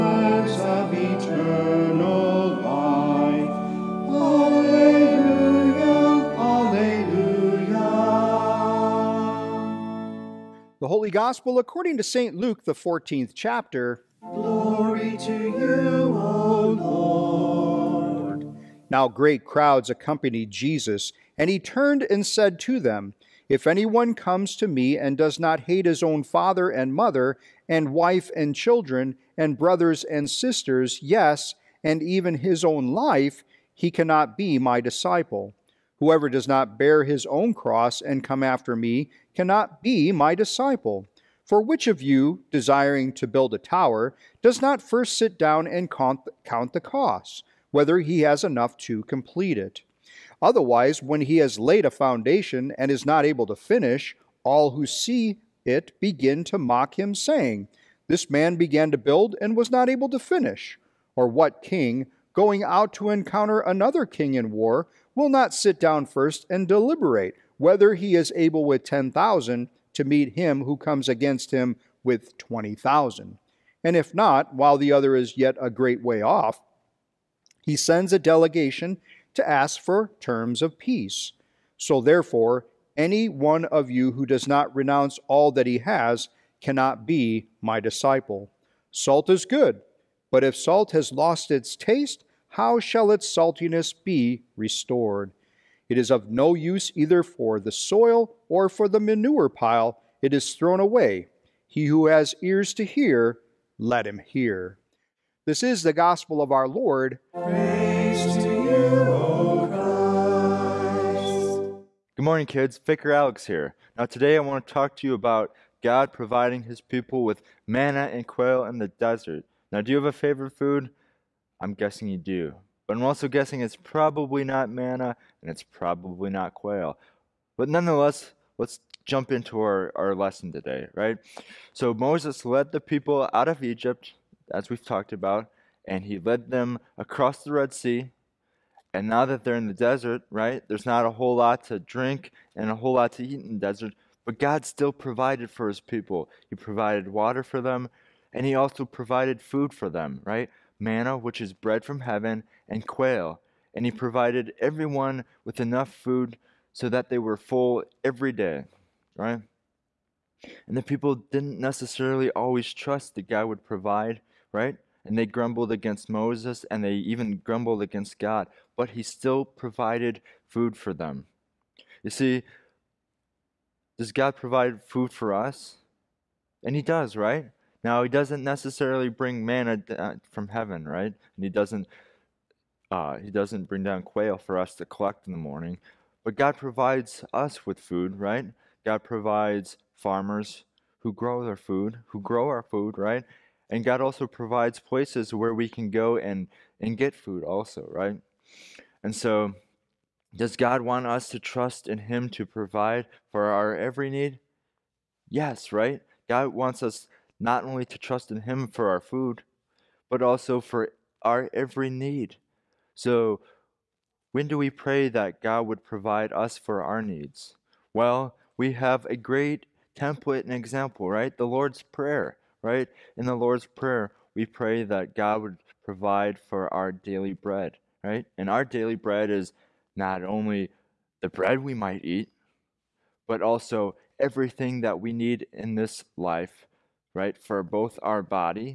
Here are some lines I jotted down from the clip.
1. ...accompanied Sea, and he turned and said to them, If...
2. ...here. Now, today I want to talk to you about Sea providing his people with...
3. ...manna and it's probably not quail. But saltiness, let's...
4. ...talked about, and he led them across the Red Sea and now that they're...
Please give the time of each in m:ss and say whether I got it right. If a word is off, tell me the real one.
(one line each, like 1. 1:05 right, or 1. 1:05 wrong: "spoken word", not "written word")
1. 0:19 wrong: "Jesus", not "Sea"
2. 1:53 wrong: "God", not "Sea"
3. 2:04 wrong: "nonetheless", not "saltiness"
4. 2:14 right.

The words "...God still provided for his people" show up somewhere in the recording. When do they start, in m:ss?
2:24.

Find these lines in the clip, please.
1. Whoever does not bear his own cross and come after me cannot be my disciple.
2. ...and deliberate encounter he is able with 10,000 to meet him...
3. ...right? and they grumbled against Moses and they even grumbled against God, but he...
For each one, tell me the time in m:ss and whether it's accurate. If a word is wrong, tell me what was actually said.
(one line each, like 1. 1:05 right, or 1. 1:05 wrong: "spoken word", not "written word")
1. 0:35 right
2. 1:06 wrong: "whether", not "encounter"
3. 2:44 right.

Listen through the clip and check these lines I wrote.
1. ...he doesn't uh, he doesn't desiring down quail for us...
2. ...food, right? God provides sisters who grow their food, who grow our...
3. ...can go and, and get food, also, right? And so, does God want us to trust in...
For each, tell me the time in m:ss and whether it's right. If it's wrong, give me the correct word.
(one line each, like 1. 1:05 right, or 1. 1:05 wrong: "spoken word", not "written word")
1. 3:01 wrong: "bring", not "desiring"
2. 3:07 wrong: "farmers", not "sisters"
3. 3:15 right.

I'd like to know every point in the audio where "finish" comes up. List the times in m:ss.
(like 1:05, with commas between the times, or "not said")
0:53, 1:00.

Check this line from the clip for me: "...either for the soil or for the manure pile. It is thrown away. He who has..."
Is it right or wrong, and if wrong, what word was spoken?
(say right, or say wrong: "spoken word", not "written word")
right.